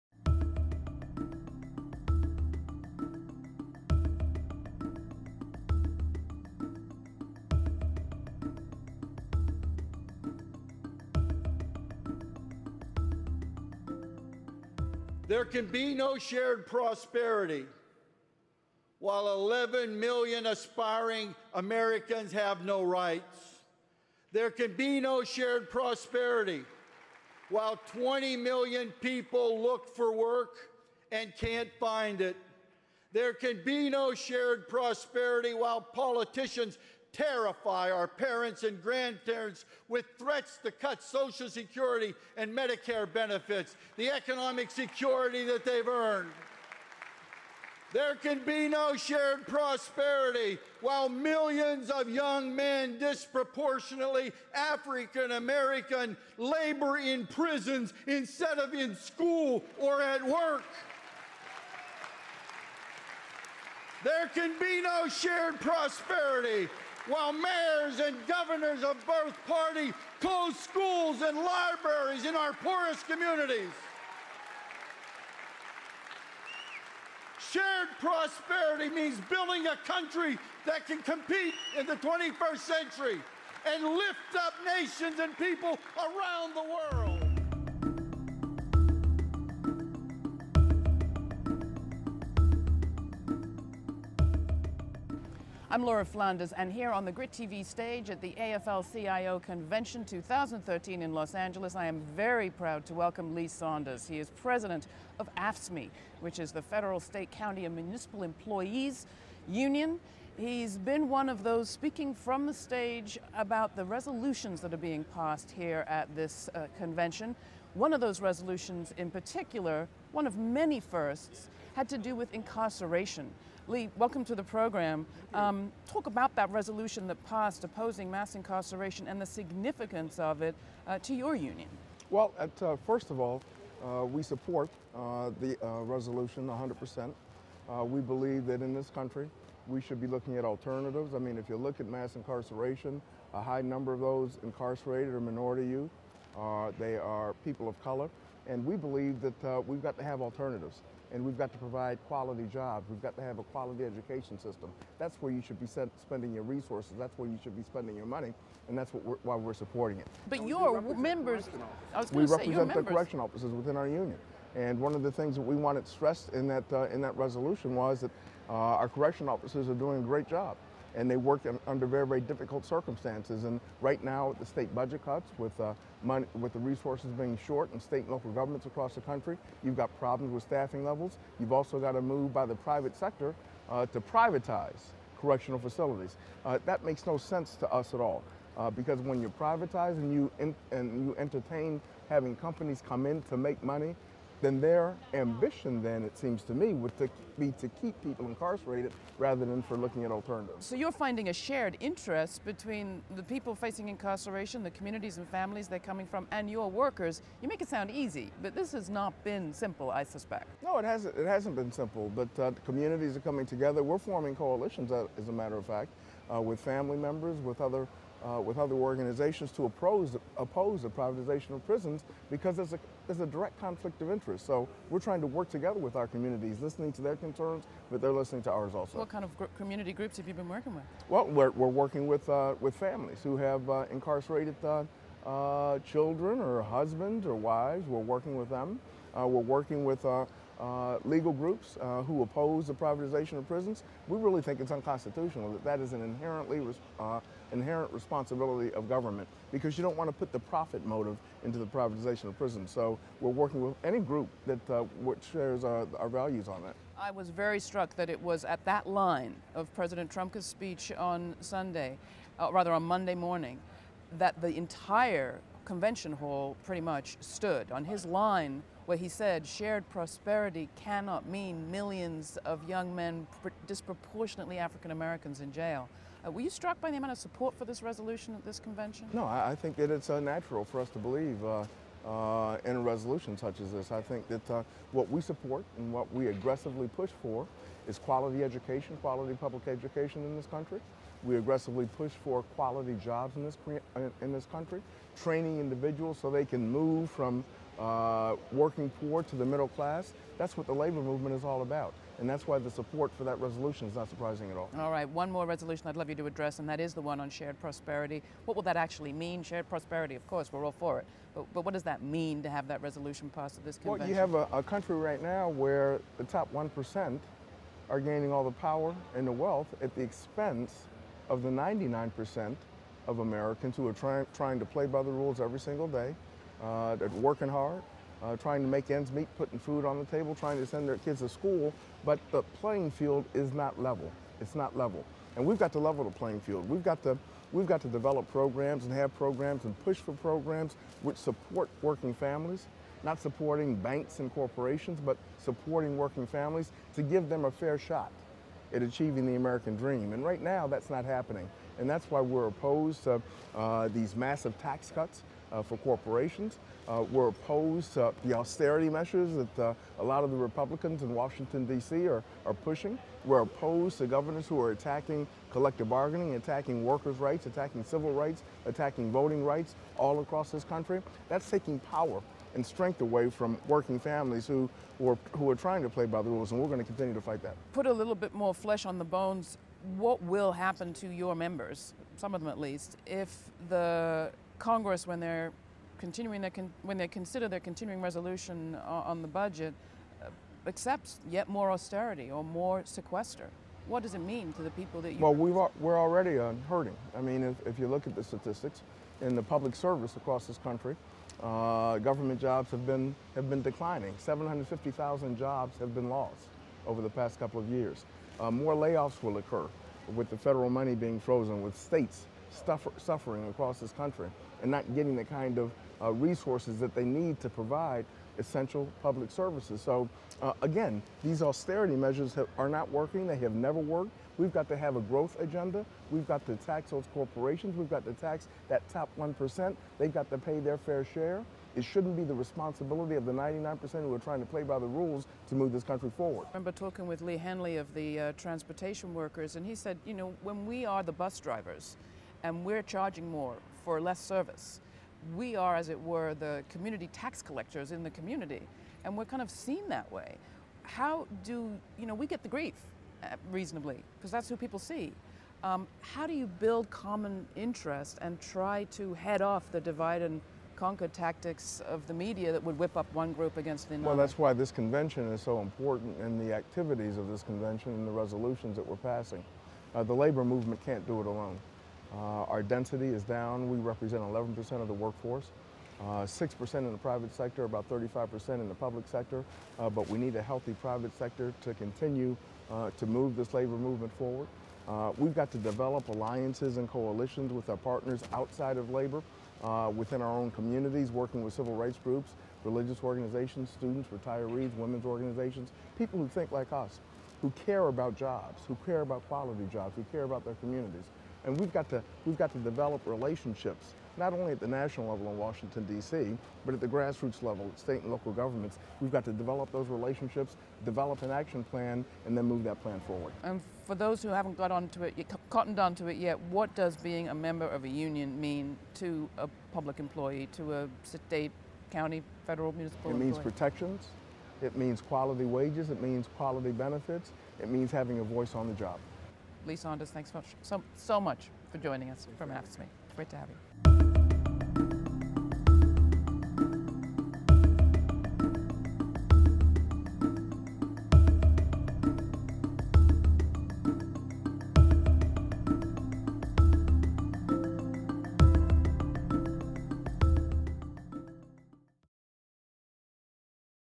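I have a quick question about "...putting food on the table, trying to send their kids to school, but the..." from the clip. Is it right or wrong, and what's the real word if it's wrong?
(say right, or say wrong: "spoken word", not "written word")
right.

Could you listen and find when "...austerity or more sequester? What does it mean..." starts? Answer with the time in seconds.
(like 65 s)
391 s.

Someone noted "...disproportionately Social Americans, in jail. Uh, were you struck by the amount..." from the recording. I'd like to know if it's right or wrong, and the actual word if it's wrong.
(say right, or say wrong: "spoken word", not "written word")
wrong: "African", not "Social".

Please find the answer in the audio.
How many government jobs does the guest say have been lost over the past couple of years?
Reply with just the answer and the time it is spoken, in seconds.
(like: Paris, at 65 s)
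750,000, at 404 s.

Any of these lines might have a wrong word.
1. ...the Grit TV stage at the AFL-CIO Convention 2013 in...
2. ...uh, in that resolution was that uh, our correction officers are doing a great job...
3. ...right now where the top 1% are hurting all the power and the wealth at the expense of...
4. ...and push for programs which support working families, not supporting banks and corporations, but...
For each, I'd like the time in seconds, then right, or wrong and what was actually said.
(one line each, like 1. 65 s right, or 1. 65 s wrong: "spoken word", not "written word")
1. 97 s right
2. 166 s right
3. 314 s wrong: "gaining", not "hurting"
4. 339 s right.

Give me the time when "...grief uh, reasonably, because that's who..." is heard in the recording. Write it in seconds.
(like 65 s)
452 s.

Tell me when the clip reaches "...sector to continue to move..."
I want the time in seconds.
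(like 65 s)
481 s.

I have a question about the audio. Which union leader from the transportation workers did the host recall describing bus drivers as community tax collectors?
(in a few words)
Lee Hanley.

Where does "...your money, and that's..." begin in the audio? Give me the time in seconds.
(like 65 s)
157 s.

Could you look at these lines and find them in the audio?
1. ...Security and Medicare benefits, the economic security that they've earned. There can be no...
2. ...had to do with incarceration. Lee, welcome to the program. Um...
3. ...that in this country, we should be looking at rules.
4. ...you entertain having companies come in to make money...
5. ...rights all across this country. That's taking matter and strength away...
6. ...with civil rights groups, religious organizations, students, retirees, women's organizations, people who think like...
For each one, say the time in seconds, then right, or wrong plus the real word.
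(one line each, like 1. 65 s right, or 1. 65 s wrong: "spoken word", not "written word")
1. 41 s right
2. 121 s right
3. 138 s wrong: "alternatives", not "rules"
4. 191 s right
5. 369 s wrong: "power", not "matter"
6. 491 s right.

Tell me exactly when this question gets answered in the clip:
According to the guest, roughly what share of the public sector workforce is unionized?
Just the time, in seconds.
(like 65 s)
477 s.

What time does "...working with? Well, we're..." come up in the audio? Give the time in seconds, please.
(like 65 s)
230 s.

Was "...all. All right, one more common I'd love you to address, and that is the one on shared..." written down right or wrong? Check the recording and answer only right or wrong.
wrong.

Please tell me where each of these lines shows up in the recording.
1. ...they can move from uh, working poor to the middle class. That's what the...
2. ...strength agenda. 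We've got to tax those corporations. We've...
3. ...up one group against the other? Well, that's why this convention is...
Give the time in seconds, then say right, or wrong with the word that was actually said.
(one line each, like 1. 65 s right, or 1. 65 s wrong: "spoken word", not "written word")
1. 296 s right
2. 425 s wrong: "growth", not "strength"
3. 462 s right.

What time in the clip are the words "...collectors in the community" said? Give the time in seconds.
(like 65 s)
447 s.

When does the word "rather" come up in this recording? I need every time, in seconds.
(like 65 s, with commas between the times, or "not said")
199 s, 262 s.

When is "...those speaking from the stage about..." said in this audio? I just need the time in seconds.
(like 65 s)
111 s.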